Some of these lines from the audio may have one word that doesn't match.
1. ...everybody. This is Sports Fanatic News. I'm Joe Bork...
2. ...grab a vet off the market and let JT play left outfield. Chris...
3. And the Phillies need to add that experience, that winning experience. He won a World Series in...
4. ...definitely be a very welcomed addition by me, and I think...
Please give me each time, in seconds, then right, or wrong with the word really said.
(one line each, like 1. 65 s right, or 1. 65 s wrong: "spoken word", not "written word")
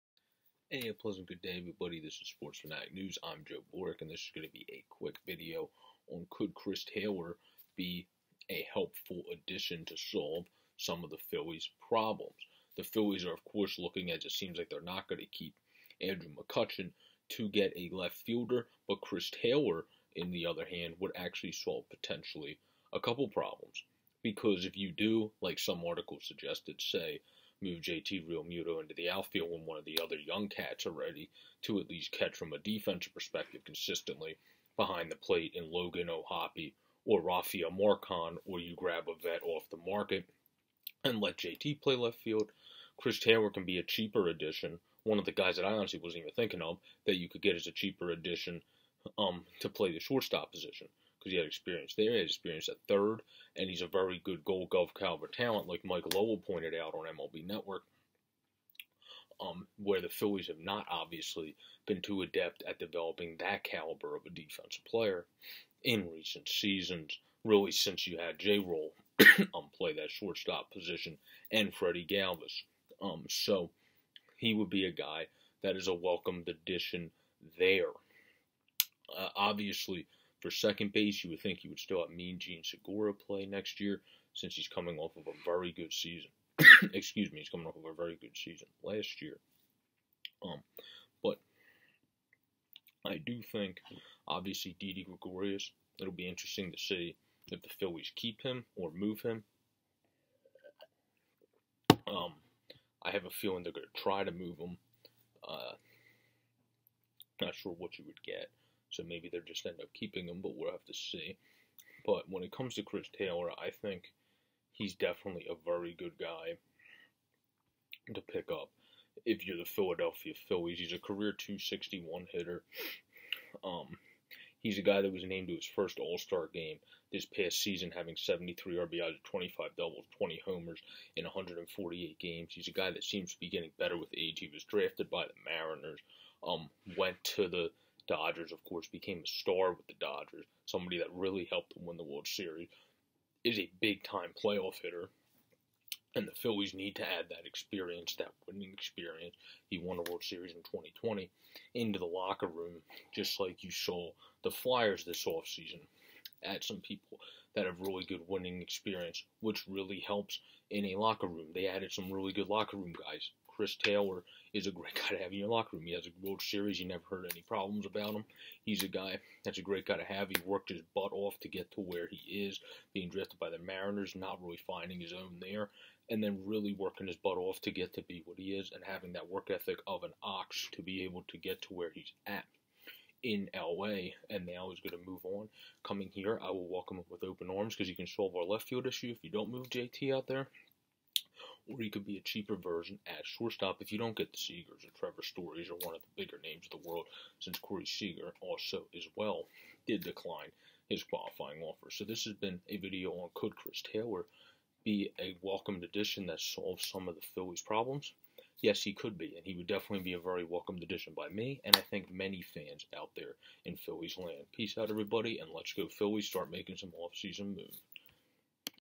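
1. 1 s right
2. 38 s wrong: "field", not "outfield"
3. 146 s right
4. 209 s right.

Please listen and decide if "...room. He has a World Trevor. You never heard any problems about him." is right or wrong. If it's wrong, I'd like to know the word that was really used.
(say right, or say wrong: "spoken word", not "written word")
wrong: "Series", not "Trevor".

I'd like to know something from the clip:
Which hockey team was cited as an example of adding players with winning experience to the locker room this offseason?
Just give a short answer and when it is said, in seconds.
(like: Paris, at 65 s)
Flyers, at 154 s.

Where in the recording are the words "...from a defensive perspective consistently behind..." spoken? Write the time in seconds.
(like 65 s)
32 s.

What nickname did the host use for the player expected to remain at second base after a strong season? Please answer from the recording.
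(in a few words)
Mean Gene.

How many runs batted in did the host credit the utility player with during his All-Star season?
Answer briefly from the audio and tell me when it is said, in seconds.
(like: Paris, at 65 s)
73, at 128 s.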